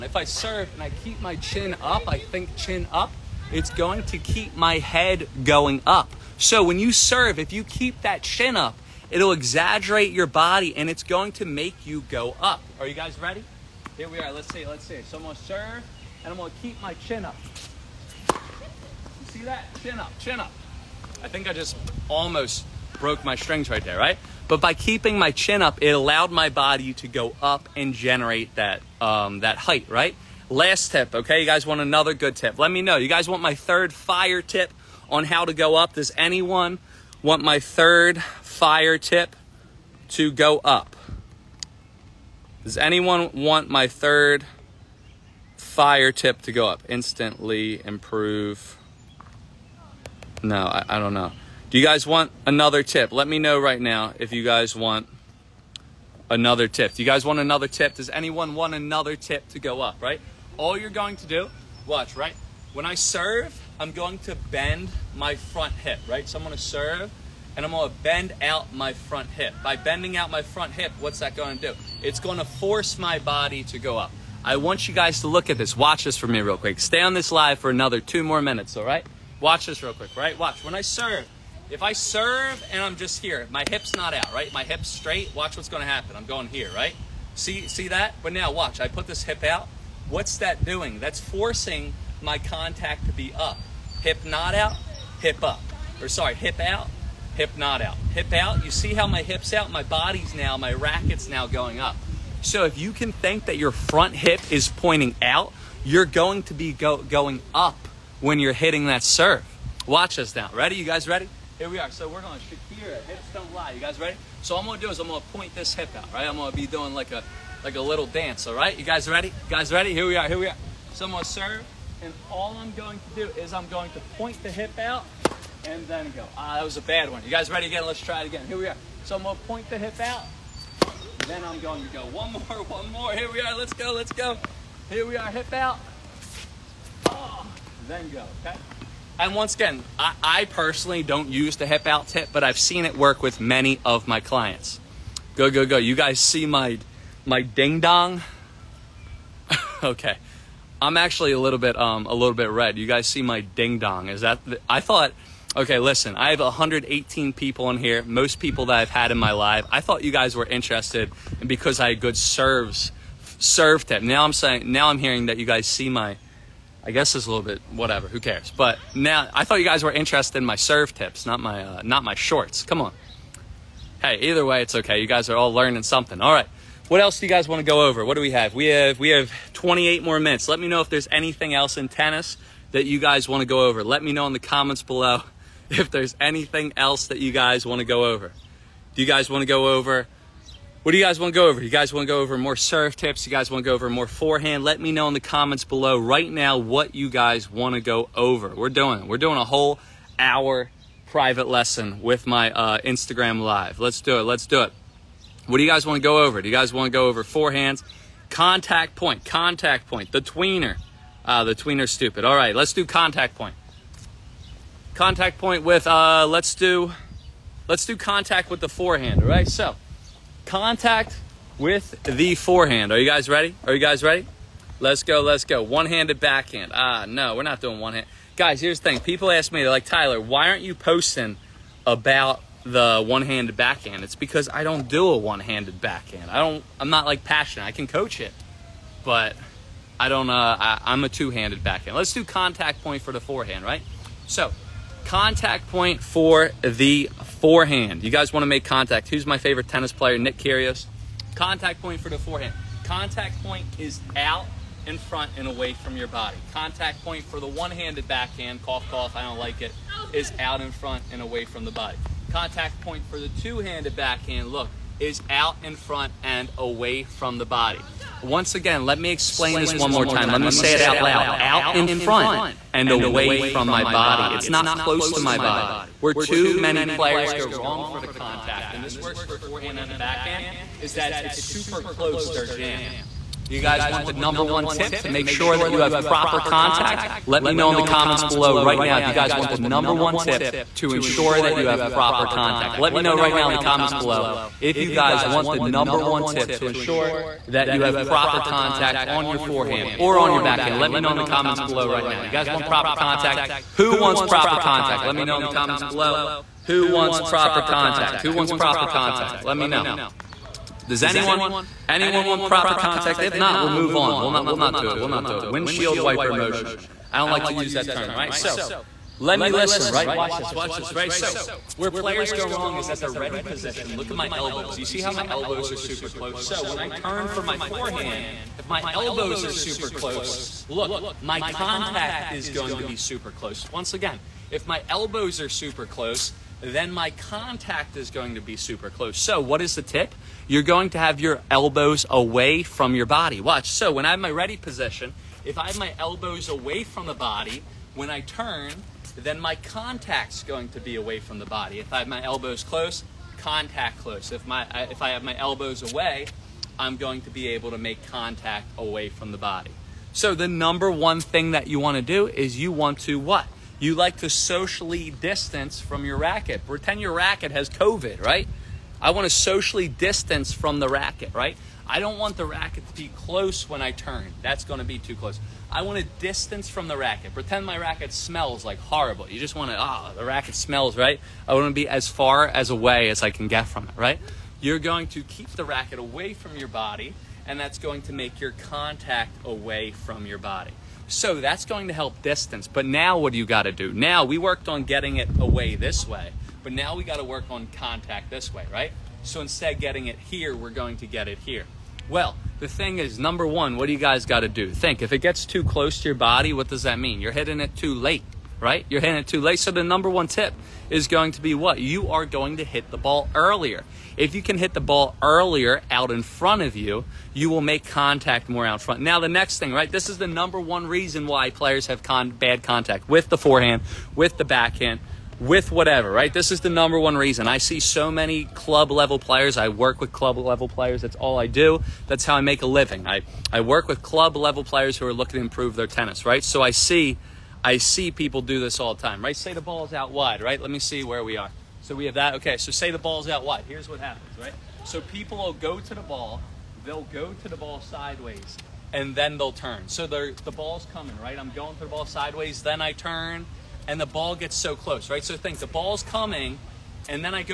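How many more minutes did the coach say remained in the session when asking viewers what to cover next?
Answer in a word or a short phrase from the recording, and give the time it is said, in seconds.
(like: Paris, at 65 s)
28, at 179 s.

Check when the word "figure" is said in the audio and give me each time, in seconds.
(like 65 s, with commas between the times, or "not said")
not said.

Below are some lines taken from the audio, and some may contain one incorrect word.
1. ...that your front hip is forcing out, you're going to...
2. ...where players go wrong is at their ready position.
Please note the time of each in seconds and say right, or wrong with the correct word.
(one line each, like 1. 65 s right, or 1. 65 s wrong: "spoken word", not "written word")
1. 103 s wrong: "pointing", not "forcing"
2. 321 s right.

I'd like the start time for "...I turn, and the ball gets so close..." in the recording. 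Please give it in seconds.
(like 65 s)
452 s.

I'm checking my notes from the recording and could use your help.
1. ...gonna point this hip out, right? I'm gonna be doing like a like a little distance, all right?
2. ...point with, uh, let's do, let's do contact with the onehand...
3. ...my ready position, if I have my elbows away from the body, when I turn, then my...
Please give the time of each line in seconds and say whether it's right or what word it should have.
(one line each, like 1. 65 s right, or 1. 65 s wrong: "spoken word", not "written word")
1. 115 s wrong: "dance", not "distance"
2. 215 s wrong: "forehand", not "onehand"
3. 344 s right.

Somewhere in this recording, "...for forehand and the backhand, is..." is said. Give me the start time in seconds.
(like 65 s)
279 s.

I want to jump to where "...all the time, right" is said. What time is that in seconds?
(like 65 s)
438 s.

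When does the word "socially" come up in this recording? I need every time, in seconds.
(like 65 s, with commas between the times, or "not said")
364 s, 369 s.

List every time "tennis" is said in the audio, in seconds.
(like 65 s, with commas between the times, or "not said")
181 s, 249 s, 435 s.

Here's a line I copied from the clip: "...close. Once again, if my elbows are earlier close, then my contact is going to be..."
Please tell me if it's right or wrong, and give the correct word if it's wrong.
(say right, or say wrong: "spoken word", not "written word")
wrong: "super", not "earlier".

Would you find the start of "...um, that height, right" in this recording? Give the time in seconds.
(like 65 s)
29 s.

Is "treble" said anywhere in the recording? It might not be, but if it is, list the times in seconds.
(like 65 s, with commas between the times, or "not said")
not said.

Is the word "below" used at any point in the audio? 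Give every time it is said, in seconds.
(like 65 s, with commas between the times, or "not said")
184 s, 195 s, 288 s, 293 s, 301 s, 305 s.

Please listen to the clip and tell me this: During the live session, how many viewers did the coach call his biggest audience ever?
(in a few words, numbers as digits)
118.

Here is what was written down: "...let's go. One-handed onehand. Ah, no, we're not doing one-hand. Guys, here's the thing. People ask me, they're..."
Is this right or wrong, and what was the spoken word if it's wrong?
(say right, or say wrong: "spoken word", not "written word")
wrong: "backhand", not "onehand".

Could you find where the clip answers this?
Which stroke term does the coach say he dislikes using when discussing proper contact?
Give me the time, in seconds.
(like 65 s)
315 s.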